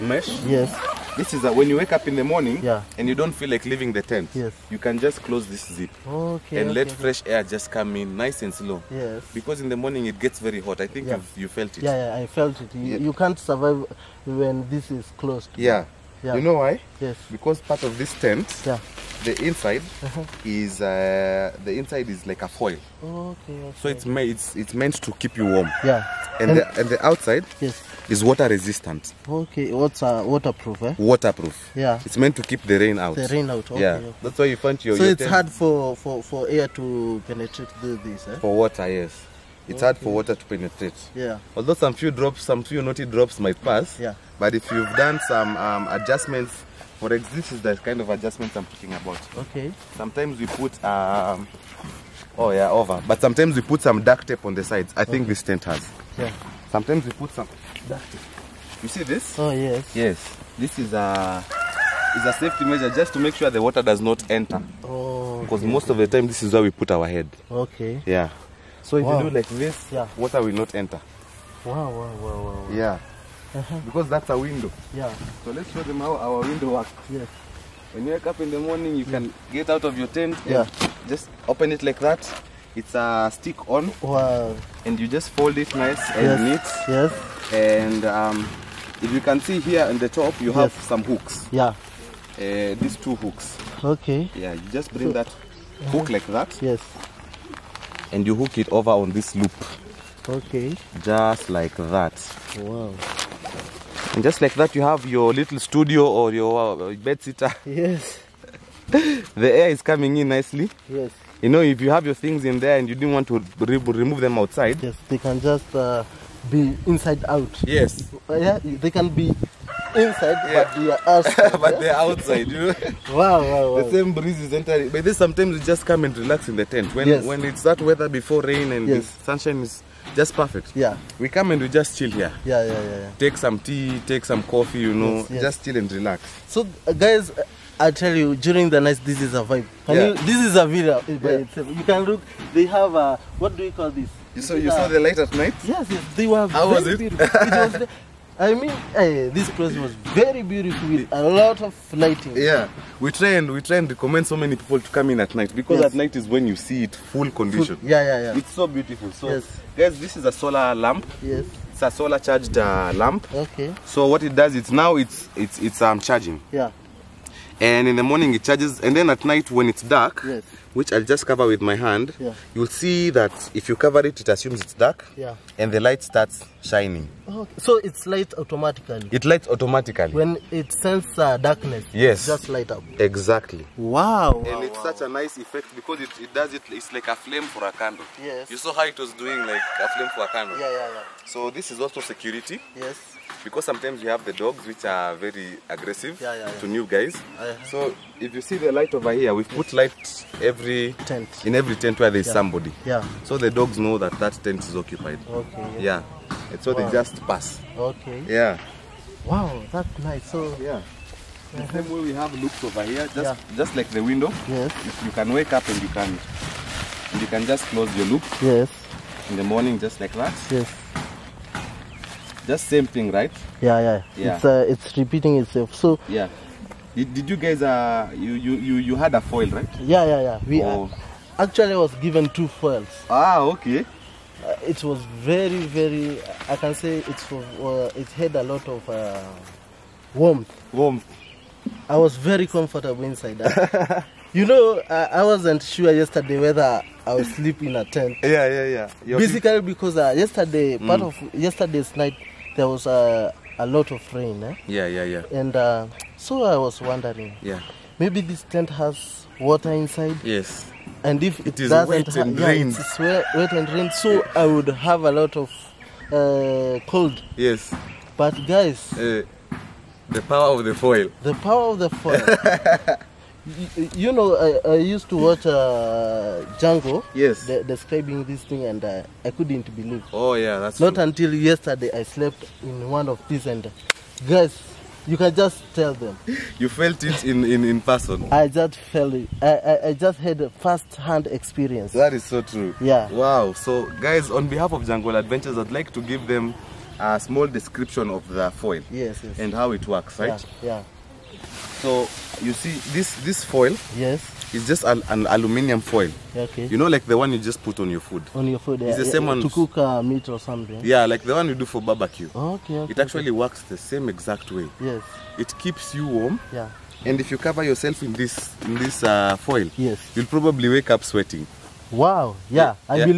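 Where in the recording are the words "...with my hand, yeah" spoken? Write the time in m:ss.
2:51.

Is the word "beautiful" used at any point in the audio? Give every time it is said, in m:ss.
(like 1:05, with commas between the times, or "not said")
2:30, 2:38.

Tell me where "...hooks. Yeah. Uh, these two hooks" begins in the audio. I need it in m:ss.
1:31.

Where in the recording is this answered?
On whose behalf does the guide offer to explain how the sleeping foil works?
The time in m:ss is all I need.
4:54.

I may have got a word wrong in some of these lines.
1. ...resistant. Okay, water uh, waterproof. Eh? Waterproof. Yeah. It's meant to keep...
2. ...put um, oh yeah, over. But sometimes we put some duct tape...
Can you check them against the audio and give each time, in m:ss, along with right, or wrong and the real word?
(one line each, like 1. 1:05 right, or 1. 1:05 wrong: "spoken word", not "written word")
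1. 0:28 right
2. 0:50 right.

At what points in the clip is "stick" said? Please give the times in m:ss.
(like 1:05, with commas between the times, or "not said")
1:23.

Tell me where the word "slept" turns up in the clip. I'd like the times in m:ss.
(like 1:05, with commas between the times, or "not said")
4:42.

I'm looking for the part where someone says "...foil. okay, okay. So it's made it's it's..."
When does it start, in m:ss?
0:22.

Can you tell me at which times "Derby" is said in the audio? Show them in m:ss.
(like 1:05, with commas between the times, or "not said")
not said.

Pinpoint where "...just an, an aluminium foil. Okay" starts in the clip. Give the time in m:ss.
5:04.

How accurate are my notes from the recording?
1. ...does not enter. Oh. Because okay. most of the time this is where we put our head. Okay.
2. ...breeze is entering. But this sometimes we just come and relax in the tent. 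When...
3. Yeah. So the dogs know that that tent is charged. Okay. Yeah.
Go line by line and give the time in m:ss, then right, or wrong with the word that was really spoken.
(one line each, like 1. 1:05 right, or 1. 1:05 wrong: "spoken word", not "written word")
1. 1:03 right
2. 2:04 right
3. 3:22 wrong: "occupied", not "charged".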